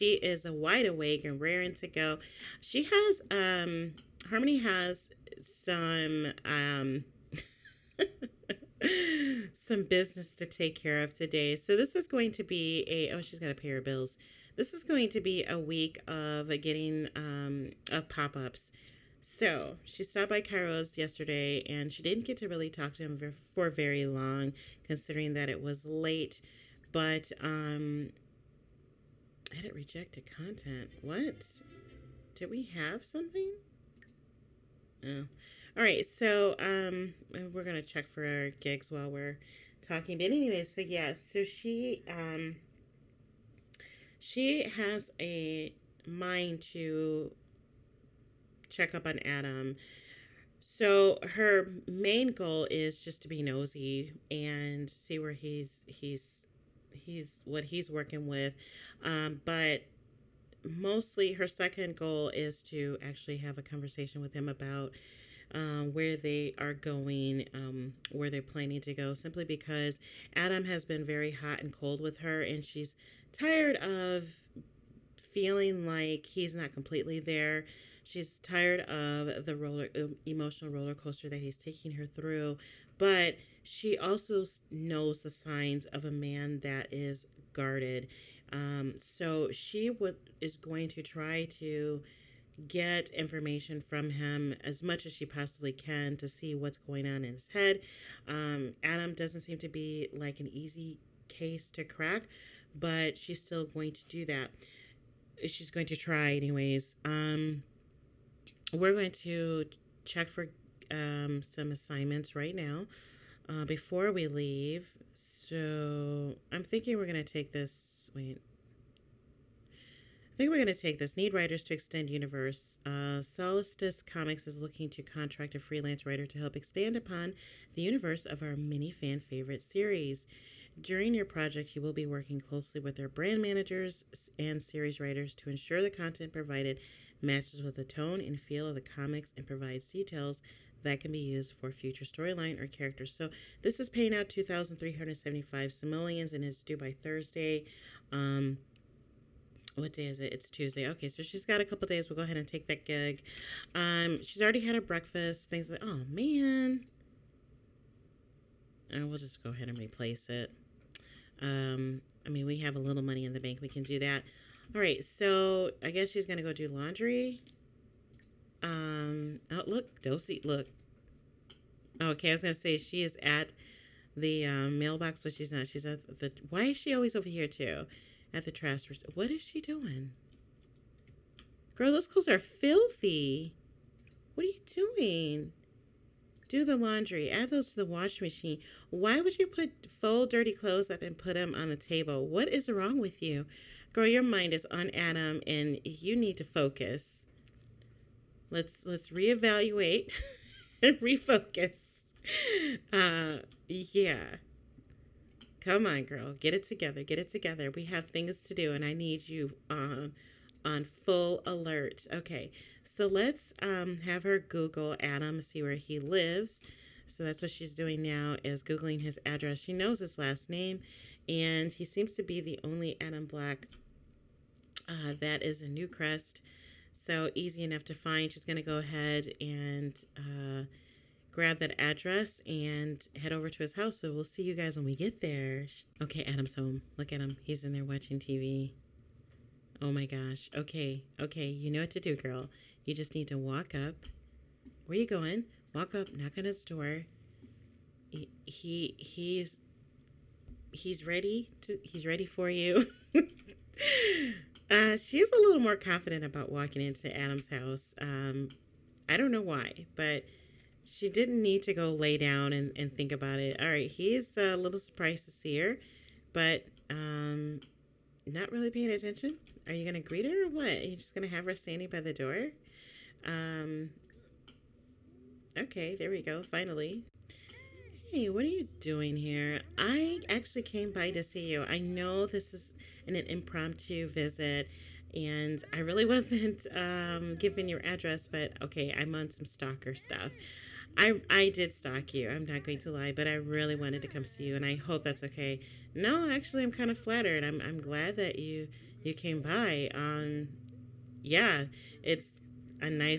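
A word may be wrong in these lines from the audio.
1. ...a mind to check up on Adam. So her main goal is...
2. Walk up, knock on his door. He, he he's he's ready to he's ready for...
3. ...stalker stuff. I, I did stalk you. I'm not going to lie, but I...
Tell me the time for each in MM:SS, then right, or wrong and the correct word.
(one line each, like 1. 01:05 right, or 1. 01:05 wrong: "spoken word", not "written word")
1. 00:45 right
2. 04:05 right
3. 04:49 right.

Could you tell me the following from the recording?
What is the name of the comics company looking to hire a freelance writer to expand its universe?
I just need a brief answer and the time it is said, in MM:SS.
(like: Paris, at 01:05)
Solstice Comics, at 02:03.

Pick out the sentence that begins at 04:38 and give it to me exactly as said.
Hey, what are you doing here?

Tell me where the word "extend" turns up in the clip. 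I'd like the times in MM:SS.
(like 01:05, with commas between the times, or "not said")
02:01.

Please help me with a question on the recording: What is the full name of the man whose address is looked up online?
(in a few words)
Adam Black.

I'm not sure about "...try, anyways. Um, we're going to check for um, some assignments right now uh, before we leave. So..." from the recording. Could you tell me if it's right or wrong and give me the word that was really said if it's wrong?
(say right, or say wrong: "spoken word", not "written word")
right.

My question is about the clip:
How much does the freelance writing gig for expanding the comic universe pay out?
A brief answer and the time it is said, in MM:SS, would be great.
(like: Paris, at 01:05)
2,375 simoleons, at 02:24.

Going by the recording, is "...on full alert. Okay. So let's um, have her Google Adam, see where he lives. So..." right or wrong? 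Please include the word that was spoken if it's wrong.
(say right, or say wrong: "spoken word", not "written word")
right.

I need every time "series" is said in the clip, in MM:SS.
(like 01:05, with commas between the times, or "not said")
02:09, 02:14.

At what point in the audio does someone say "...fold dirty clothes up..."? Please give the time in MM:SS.
03:10.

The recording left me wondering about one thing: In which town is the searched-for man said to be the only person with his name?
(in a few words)
Newcrest.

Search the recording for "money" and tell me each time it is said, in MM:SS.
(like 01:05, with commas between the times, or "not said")
02:43.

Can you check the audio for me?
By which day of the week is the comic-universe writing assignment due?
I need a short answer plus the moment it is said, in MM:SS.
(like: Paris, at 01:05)
Thursday, at 02:27.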